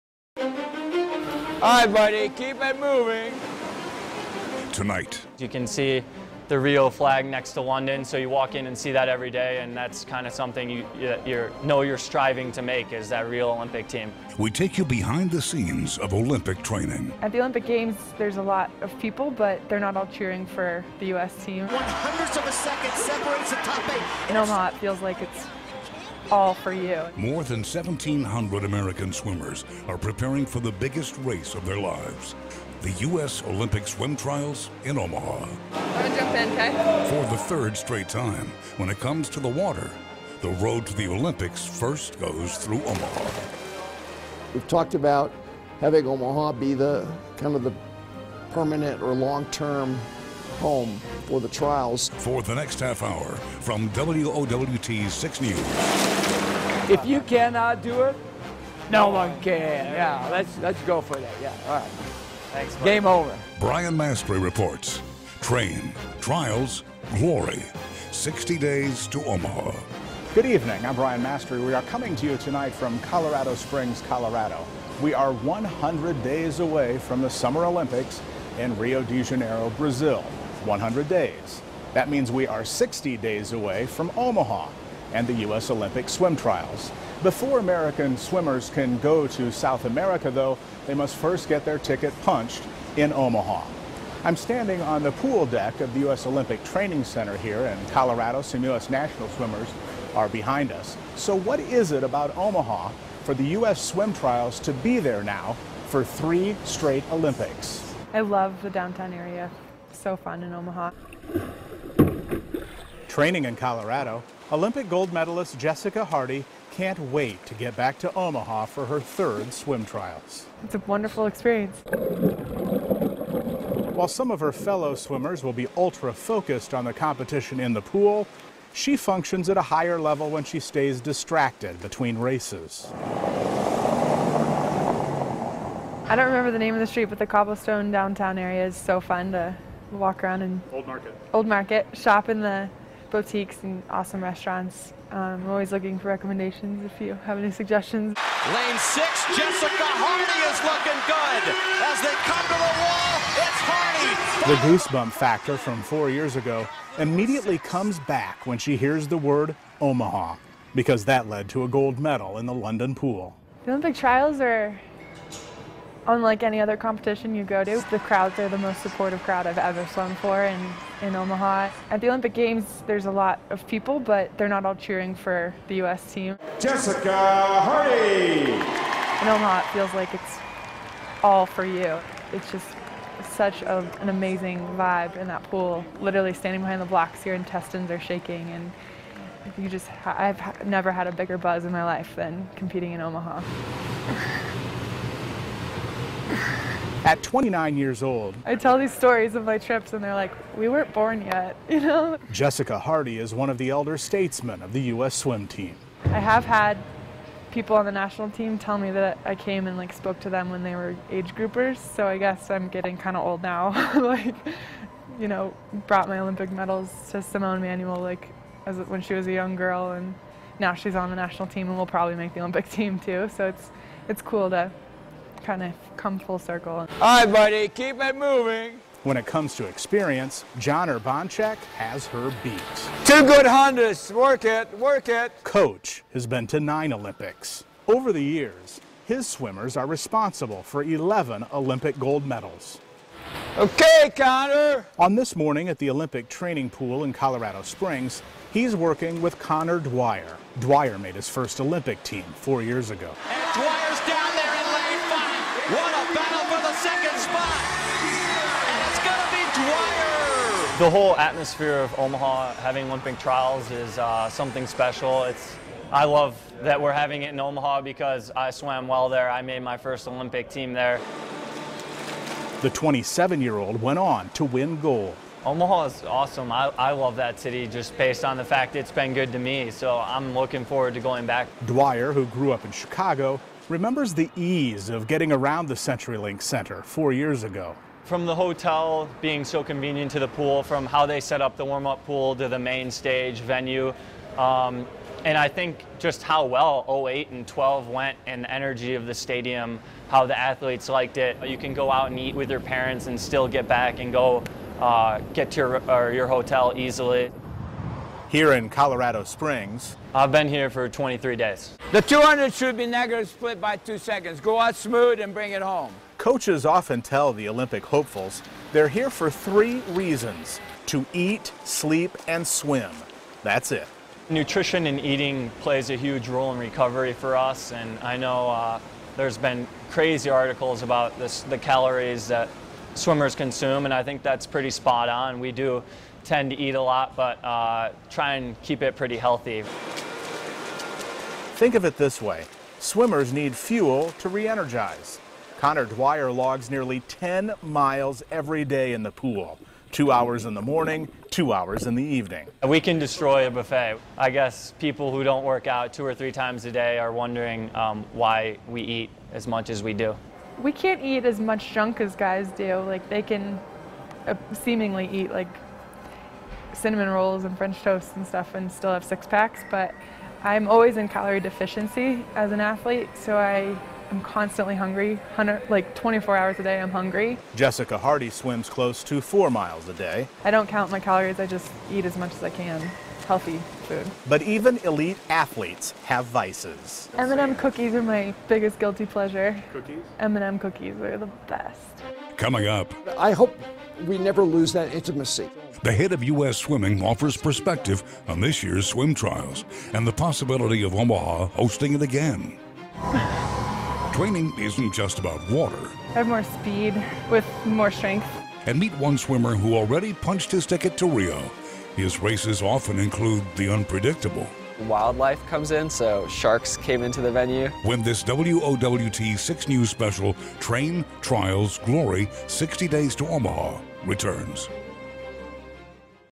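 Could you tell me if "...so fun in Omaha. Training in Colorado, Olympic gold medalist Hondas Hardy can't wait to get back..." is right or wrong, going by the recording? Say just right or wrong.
wrong.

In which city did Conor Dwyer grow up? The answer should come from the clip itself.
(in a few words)
Chicago.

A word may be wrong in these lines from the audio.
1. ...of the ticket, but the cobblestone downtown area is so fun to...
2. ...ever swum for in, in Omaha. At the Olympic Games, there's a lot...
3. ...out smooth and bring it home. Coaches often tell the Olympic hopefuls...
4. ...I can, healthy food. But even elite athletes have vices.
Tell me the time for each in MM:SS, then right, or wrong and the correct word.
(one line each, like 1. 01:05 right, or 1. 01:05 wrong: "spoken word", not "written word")
1. 02:16 wrong: "street", not "ticket"
2. 02:49 right
3. 05:14 right
4. 06:22 right.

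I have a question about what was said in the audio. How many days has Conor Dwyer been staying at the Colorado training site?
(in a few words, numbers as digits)
23.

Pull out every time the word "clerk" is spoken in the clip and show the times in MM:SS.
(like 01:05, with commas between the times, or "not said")
not said.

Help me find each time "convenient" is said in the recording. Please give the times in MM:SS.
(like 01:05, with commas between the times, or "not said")
04:49.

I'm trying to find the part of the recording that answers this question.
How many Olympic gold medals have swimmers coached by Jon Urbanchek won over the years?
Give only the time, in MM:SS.
04:00.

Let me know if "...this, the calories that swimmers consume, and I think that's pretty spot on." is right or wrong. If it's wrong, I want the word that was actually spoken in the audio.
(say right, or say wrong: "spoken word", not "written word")
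right.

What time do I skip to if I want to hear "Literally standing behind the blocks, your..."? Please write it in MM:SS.
03:05.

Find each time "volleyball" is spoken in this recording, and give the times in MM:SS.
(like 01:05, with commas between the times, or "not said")
not said.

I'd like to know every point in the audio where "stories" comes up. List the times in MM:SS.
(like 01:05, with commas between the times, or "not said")
03:18.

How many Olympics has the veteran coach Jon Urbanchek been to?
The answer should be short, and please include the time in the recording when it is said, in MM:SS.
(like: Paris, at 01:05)
9, at 03:56.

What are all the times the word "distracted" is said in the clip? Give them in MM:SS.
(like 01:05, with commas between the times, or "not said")
02:11.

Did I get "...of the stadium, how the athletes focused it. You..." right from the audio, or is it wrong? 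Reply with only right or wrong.
wrong.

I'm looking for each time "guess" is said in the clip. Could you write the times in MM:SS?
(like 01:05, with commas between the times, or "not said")
03:32, 05:54.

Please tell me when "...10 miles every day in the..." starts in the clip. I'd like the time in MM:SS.
05:47.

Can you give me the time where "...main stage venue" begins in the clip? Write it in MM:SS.
04:52.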